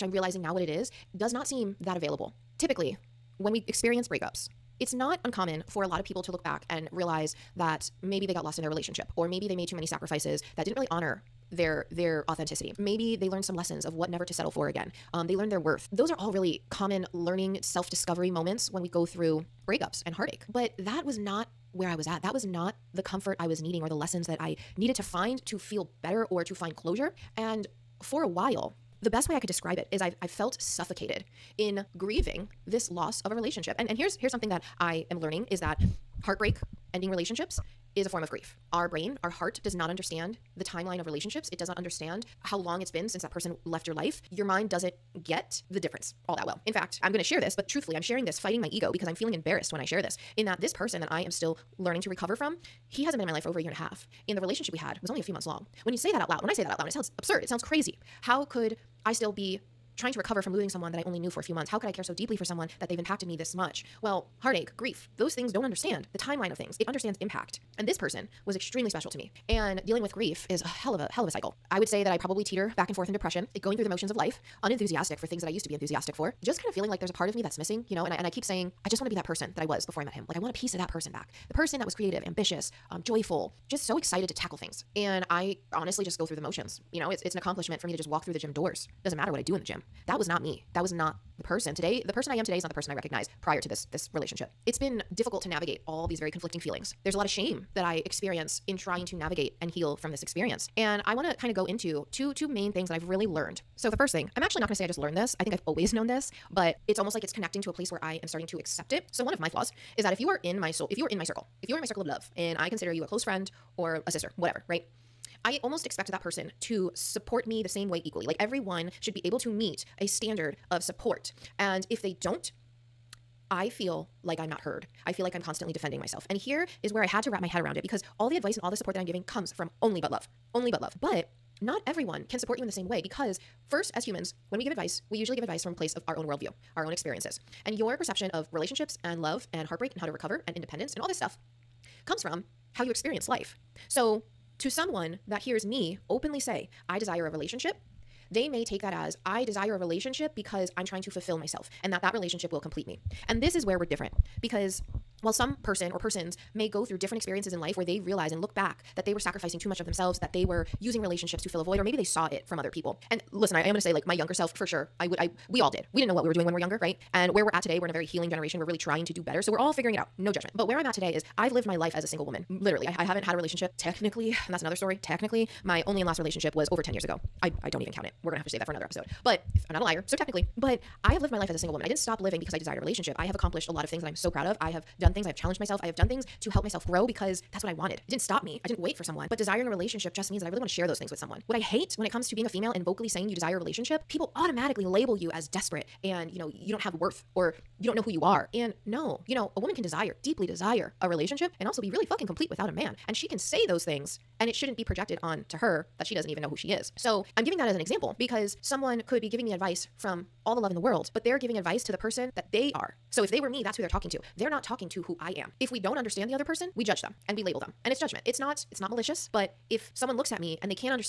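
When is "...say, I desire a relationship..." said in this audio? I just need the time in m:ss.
2:26.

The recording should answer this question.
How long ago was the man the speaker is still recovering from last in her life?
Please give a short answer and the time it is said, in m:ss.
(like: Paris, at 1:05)
Over a year and a half, at 0:53.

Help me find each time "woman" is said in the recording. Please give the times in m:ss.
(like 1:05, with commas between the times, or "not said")
2:52, 3:01, 3:19.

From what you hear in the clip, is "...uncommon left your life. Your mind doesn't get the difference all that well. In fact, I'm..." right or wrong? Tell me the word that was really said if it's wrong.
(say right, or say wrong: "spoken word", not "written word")
wrong: "person", not "uncommon".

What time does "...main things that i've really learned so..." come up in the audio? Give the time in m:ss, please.
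1:42.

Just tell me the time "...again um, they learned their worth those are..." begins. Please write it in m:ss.
0:14.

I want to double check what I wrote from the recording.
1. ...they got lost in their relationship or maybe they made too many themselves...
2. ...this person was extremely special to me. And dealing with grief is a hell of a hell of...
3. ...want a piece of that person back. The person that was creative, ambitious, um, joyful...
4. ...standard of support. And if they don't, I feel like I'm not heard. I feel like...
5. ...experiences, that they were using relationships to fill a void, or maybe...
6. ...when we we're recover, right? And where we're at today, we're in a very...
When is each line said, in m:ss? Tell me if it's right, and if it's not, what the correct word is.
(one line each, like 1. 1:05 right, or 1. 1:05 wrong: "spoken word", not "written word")
1. 0:08 wrong: "sacrifices", not "themselves"
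2. 1:07 right
3. 1:20 right
4. 2:00 right
5. 2:39 wrong: "themselves", not "experiences"
6. 2:46 wrong: "younger", not "recover".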